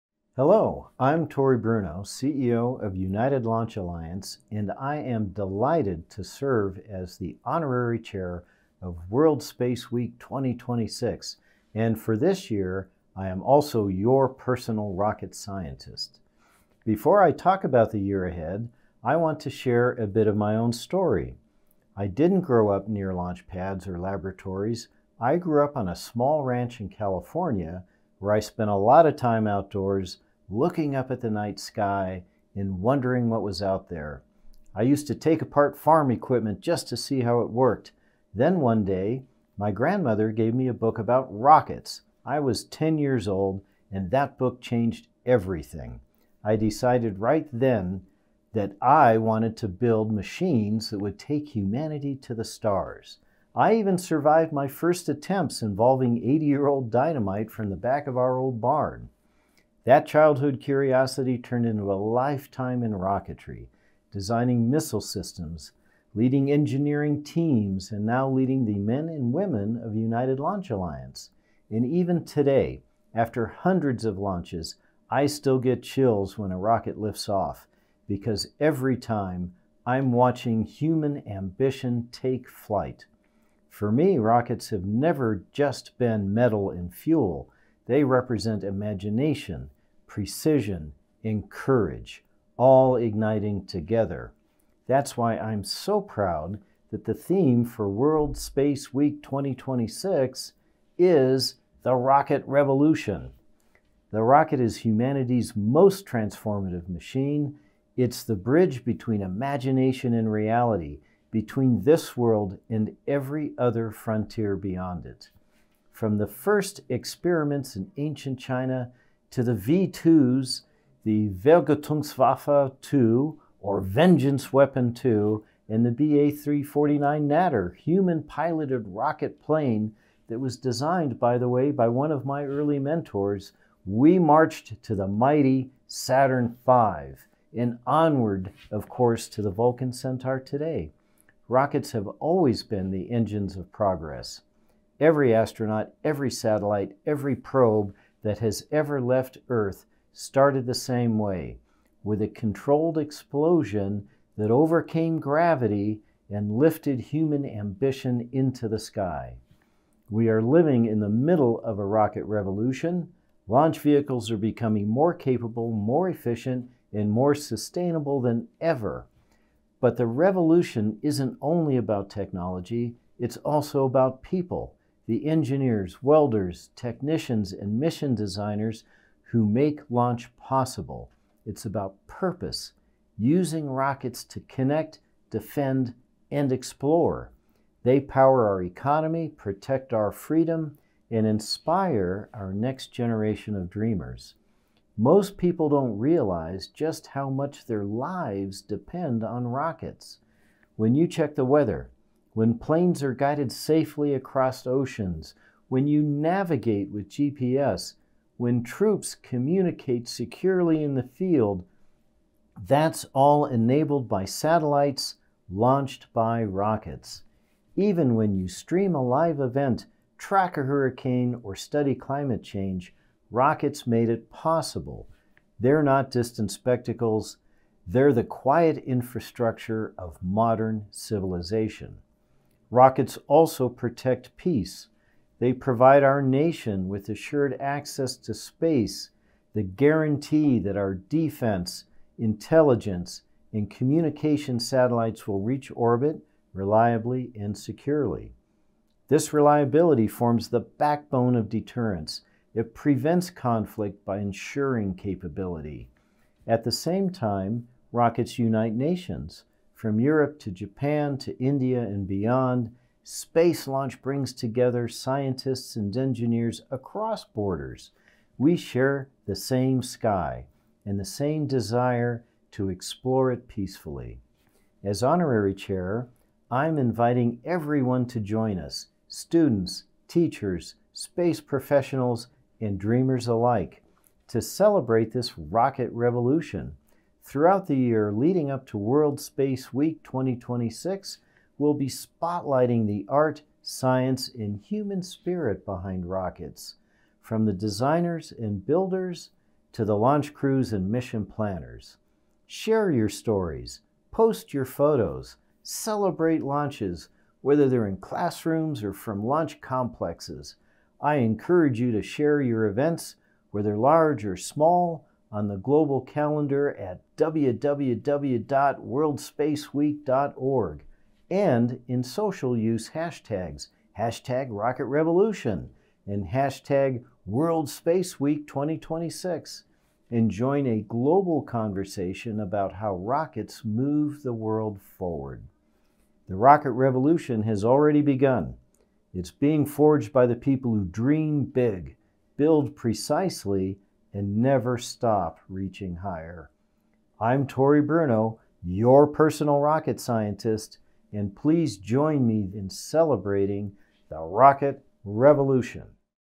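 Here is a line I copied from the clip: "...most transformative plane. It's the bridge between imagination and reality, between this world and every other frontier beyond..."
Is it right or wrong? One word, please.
wrong.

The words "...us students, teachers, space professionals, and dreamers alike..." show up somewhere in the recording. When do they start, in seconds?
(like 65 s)
278 s.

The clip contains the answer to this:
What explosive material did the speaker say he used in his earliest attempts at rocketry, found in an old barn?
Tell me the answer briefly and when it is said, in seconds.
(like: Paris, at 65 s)
80 year old dynamite, at 56 s.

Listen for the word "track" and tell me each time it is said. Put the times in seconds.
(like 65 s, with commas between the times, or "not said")
220 s.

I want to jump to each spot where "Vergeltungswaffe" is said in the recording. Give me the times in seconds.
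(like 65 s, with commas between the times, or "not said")
121 s.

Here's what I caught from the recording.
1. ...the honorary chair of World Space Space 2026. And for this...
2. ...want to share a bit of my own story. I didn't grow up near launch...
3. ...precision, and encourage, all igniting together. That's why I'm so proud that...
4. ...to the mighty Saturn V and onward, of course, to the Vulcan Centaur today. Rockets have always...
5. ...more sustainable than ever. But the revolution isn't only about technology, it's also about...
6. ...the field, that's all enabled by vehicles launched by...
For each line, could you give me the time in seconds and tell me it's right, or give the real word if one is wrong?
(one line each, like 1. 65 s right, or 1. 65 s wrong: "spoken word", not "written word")
1. 7 s wrong: "Week", not "Space"
2. 19 s right
3. 90 s wrong: "courage", not "encourage"
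4. 134 s right
5. 167 s right
6. 210 s wrong: "satellites", not "vehicles".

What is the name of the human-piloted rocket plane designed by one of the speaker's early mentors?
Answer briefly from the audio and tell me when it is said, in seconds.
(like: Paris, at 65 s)
BA 349 Natter, at 125 s.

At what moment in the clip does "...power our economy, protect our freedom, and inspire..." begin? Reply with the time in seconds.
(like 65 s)
187 s.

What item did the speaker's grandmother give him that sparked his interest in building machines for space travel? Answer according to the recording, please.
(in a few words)
A book about rockets.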